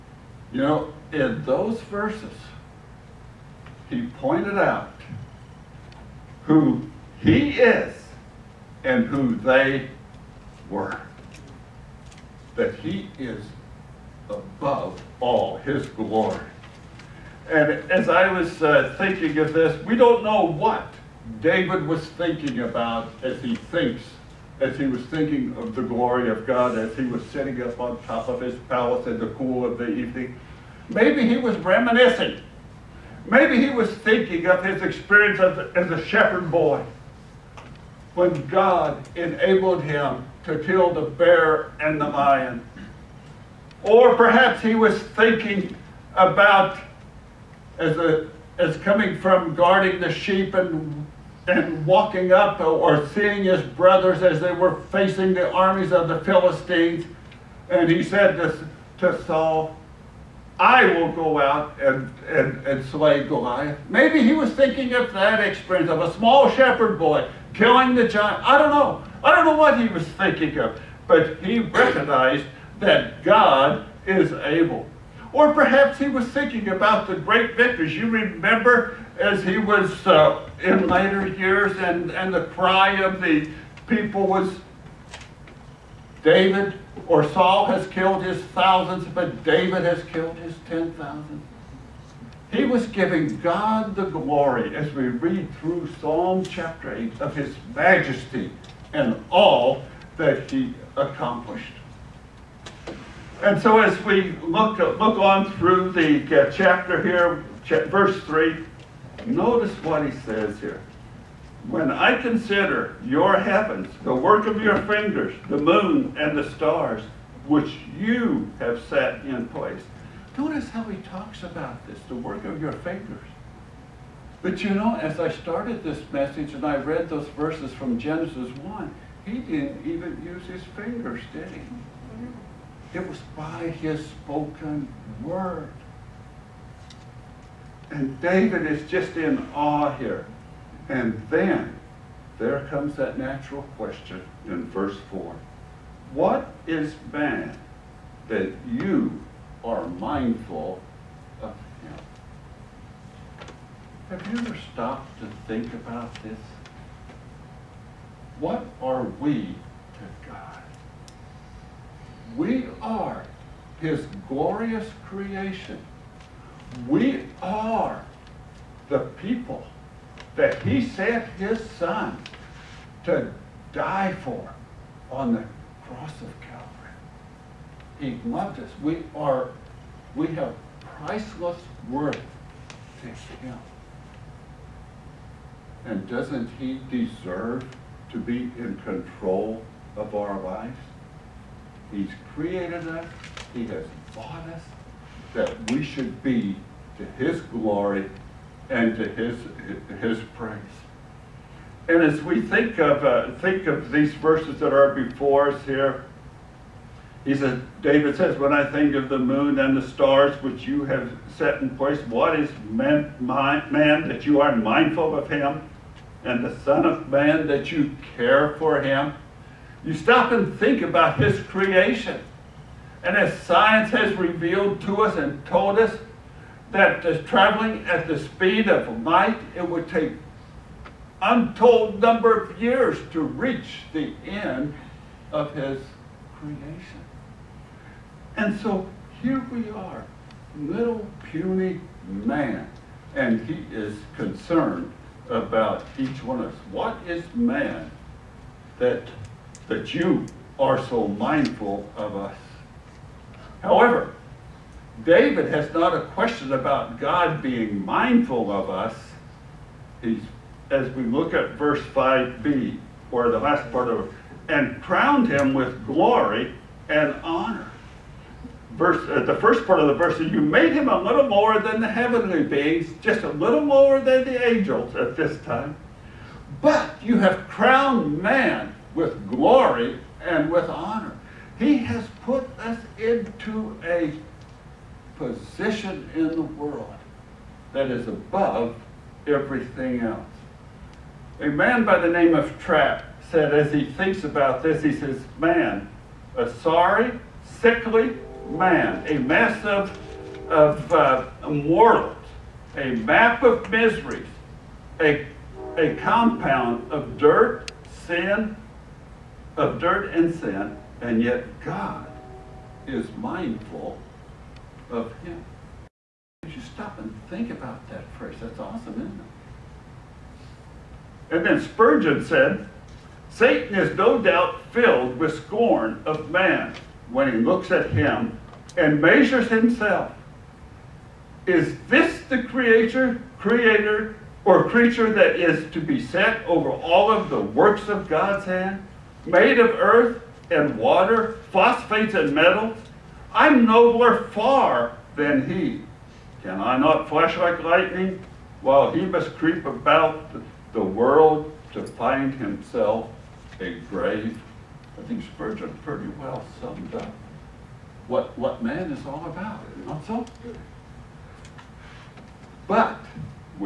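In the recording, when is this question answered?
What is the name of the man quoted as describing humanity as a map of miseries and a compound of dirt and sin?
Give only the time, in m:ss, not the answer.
4:52.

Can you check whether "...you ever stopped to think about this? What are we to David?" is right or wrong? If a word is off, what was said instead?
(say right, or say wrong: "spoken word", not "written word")
wrong: "God", not "David".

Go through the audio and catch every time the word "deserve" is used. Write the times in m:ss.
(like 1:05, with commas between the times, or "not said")
3:06.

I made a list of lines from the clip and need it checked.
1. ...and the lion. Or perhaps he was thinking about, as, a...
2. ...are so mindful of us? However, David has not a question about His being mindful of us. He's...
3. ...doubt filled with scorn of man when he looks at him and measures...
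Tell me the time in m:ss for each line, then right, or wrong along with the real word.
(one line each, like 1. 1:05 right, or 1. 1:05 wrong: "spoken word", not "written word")
1. 0:41 right
2. 4:10 wrong: "God", not "His"
3. 5:24 right.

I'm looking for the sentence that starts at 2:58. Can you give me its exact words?
we are, we have priceless worth to him.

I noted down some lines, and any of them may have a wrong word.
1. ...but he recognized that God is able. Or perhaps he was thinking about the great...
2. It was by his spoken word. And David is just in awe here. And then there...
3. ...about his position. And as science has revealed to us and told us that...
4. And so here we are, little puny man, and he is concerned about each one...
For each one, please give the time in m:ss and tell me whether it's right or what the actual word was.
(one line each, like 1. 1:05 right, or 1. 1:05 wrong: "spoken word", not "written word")
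1. 1:11 right
2. 2:12 right
3. 3:40 wrong: "creation", not "position"
4. 3:58 right.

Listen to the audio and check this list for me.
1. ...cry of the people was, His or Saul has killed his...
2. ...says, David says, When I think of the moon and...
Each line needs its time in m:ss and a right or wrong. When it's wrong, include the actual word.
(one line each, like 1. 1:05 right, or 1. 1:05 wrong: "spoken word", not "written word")
1. 1:22 wrong: "David", not "His"
2. 3:27 right.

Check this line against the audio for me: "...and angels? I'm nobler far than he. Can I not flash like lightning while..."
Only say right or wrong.
wrong.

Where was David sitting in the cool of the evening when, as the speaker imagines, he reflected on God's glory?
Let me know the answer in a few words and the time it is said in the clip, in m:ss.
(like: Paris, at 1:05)
On top of his palace, at 0:27.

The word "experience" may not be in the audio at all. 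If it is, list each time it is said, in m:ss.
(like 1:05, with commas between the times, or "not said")
0:34, 1:05.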